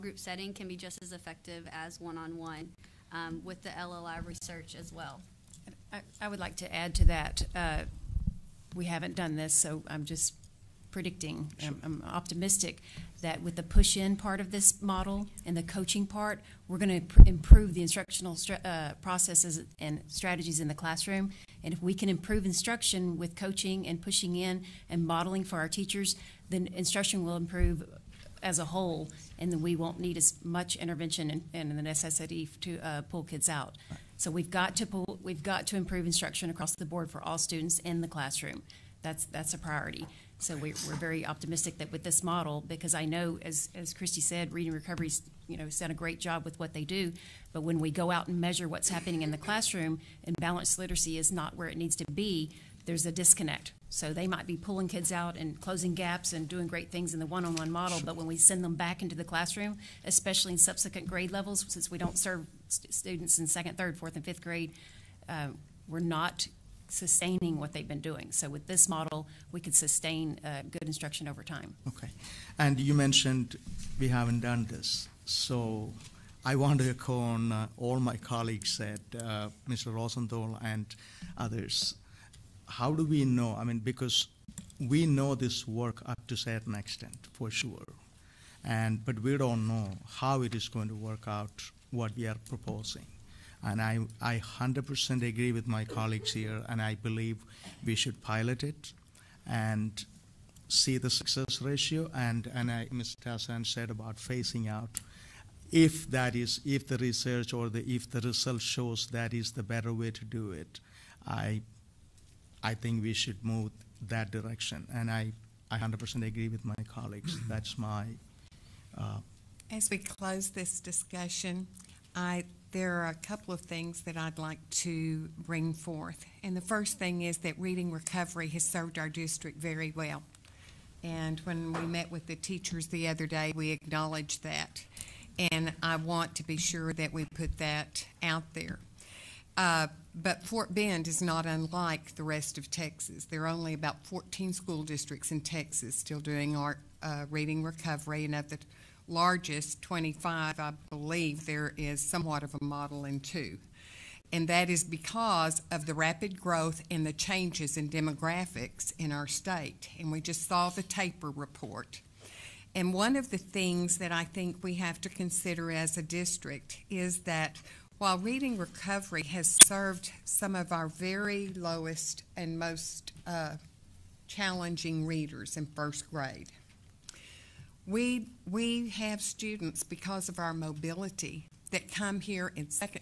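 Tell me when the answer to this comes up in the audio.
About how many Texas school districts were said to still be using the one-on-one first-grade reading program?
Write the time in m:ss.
2:24.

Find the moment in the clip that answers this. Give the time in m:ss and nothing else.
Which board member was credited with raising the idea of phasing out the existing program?
1:42.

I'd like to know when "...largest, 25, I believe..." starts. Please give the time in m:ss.
2:29.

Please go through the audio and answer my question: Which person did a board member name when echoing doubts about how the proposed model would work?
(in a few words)
Mr. Rosenthal.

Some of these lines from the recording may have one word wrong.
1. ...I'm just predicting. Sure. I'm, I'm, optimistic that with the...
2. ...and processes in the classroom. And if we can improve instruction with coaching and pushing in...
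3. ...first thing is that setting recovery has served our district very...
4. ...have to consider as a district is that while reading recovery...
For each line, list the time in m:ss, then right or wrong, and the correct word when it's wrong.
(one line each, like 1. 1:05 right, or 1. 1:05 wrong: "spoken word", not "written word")
1. 0:09 right
2. 0:19 wrong: "strategies", not "processes"
3. 2:06 wrong: "reading", not "setting"
4. 2:44 right.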